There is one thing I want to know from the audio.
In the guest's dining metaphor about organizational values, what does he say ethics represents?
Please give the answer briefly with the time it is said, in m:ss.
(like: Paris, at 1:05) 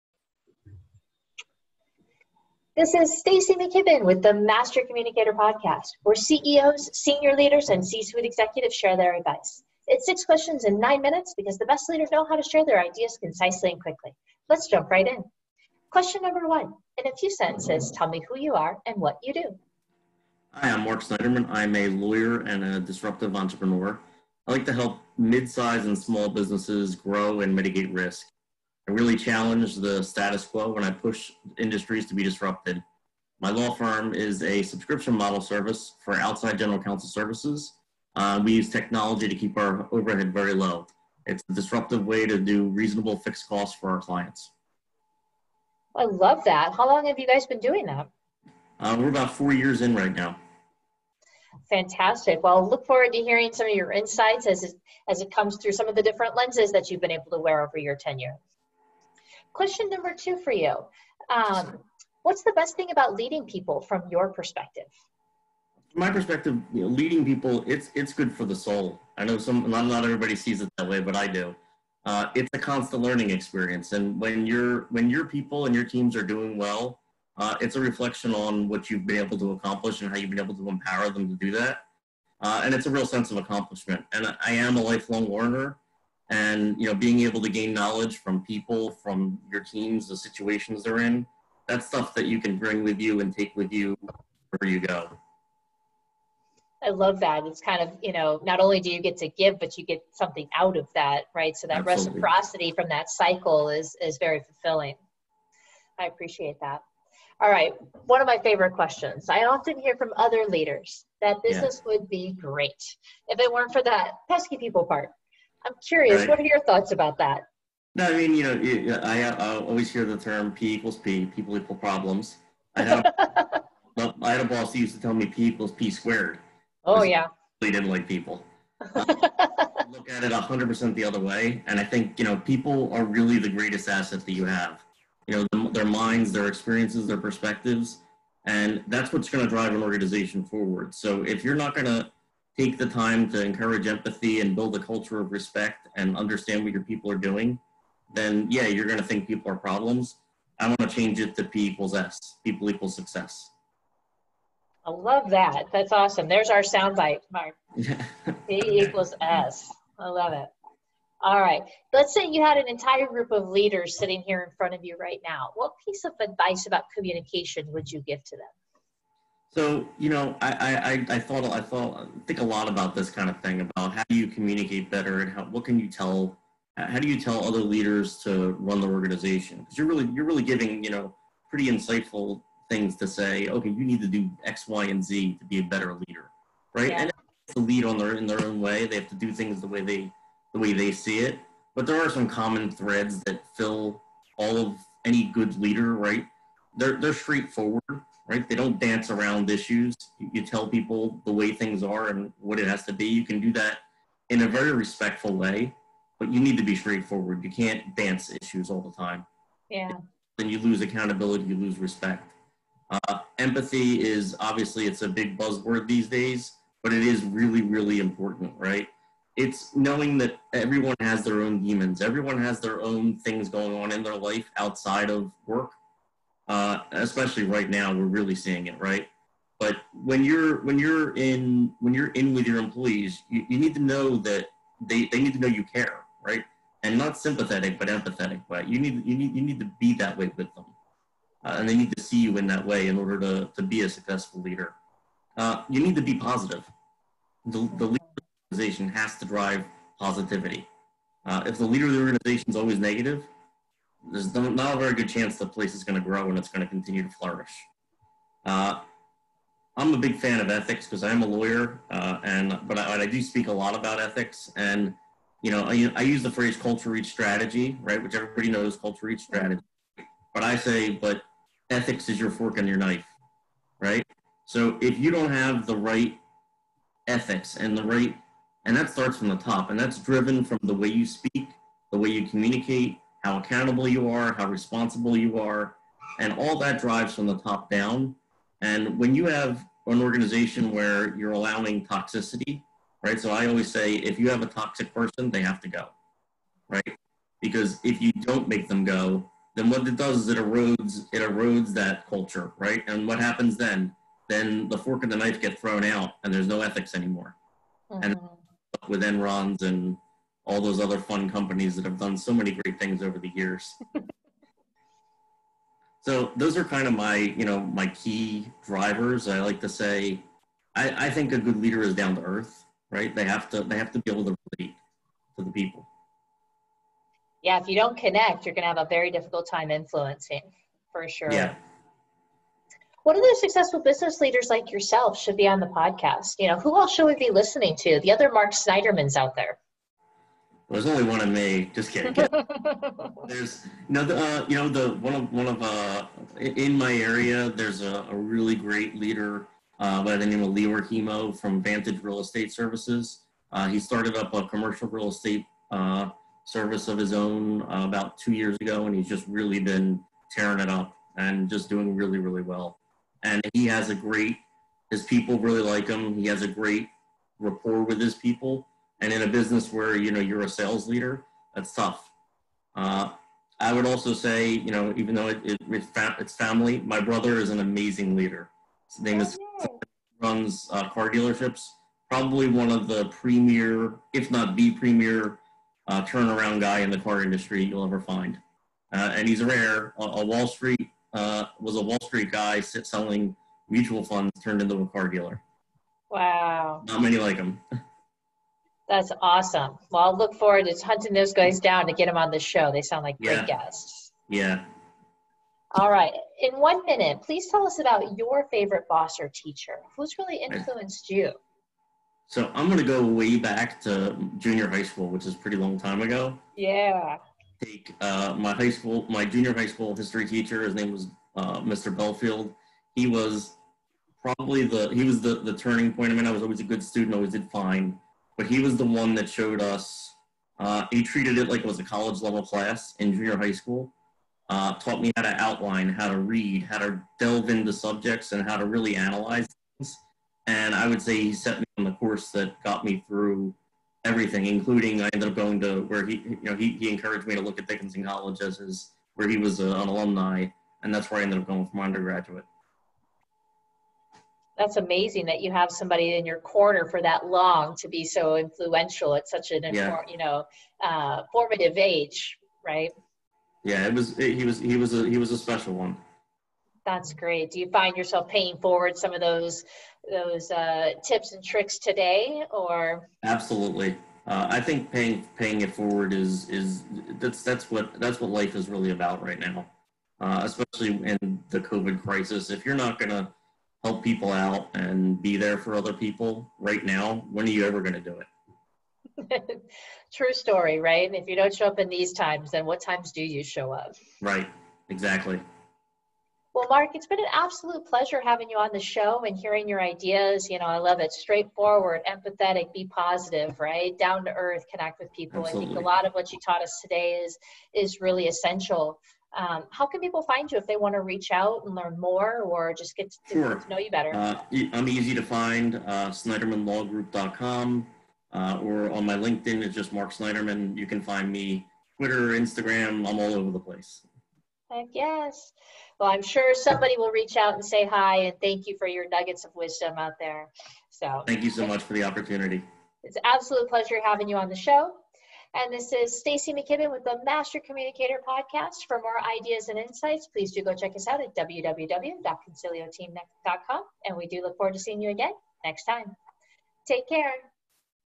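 your fork and your knife, at 4:31.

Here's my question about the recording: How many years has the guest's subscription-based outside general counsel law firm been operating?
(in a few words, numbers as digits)
4.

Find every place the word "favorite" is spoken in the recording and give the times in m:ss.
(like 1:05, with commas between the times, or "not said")
1:48, 6:48.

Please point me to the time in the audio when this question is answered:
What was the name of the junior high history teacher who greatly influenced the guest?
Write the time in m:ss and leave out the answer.
7:01.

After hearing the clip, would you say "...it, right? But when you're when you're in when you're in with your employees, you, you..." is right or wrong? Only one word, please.
right.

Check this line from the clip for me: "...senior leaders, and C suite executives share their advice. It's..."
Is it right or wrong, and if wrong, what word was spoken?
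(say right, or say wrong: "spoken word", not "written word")
right.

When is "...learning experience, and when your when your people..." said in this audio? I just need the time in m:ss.
1:13.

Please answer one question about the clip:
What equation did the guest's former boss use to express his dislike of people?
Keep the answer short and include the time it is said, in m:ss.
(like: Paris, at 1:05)
P equals P squared, at 2:05.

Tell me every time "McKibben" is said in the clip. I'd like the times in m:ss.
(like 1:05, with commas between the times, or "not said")
0:03, 8:56.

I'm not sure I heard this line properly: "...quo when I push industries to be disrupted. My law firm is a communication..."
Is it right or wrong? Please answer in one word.
wrong.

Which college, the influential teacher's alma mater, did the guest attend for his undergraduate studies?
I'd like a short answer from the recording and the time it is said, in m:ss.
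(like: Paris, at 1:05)
Dickinson College, at 7:27.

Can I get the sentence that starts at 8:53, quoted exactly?
It's an absolute pleasure having you on the show.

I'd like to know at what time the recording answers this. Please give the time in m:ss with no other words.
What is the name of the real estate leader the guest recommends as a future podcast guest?
5:50.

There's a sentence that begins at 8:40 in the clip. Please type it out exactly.
You can find me Twitter, Instagram, I'm all over the place.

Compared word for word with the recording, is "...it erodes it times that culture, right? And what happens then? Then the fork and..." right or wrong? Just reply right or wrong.
wrong.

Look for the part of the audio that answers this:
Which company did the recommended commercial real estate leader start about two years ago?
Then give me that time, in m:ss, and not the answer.
5:51.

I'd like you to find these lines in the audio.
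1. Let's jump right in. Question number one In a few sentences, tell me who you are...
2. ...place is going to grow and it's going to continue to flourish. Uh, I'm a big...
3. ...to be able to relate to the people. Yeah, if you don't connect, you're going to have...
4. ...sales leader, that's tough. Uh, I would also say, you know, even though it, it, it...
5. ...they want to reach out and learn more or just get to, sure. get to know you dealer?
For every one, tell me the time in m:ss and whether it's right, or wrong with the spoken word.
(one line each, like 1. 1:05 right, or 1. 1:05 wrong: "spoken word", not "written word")
1. 0:14 right
2. 4:15 right
3. 5:23 right
4. 6:10 right
5. 8:30 wrong: "better", not "dealer".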